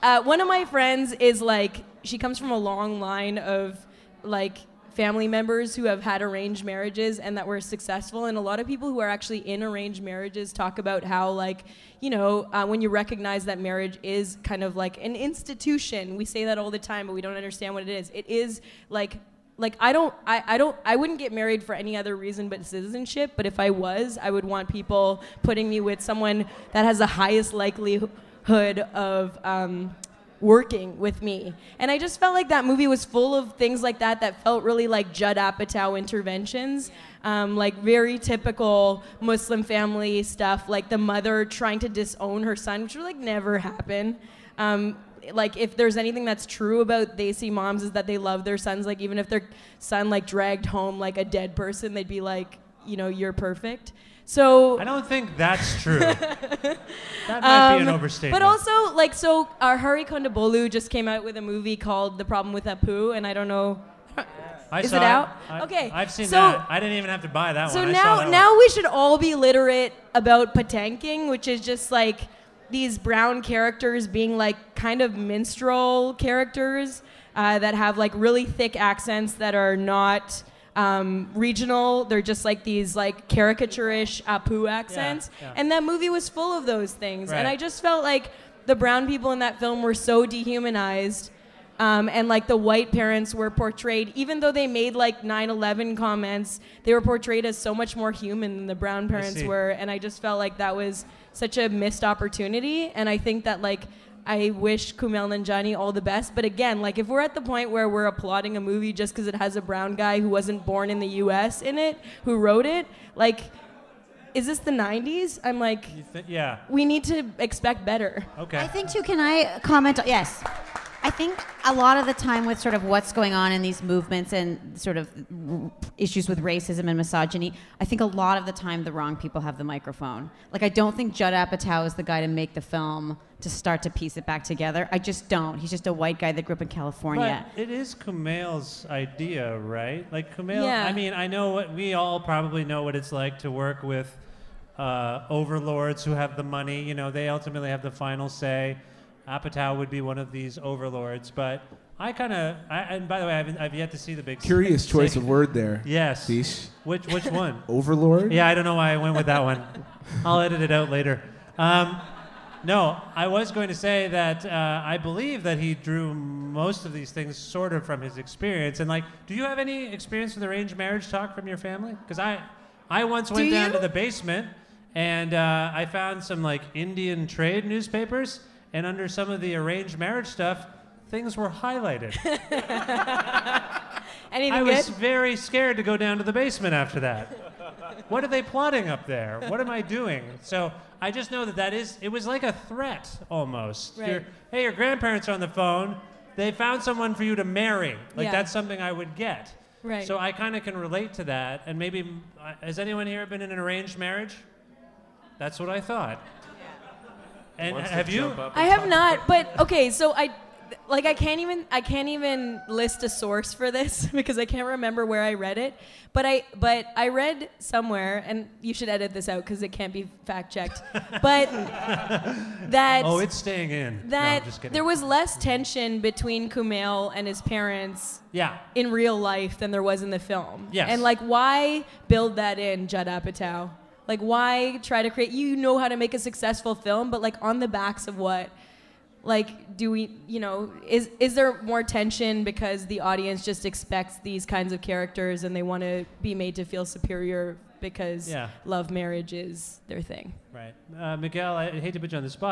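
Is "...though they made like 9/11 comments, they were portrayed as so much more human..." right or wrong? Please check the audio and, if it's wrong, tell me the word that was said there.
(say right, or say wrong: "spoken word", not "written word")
right.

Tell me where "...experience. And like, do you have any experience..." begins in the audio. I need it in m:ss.
2:48.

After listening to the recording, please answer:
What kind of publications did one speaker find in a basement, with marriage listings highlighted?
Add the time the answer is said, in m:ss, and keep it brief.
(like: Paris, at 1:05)
Indian trade newspapers, at 2:56.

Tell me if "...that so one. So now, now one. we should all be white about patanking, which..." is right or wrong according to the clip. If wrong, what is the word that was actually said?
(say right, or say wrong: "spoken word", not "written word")
wrong: "literate", not "white".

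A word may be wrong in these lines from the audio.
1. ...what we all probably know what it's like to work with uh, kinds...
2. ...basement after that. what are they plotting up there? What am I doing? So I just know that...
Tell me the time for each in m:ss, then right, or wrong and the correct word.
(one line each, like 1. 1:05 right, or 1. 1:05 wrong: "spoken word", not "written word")
1. 2:21 wrong: "overlords", not "kinds"
2. 3:06 right.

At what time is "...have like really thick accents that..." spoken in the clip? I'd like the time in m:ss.
1:17.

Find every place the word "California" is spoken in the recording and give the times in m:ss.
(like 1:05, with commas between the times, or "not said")
2:16.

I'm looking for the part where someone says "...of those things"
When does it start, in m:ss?
1:26.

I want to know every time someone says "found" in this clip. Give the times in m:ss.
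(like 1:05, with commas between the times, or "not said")
2:55, 3:16.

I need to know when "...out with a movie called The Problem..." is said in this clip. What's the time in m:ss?
1:01.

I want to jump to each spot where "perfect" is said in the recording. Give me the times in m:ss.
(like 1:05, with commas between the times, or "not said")
0:53.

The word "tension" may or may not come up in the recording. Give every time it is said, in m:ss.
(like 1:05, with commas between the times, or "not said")
3:45, 4:01.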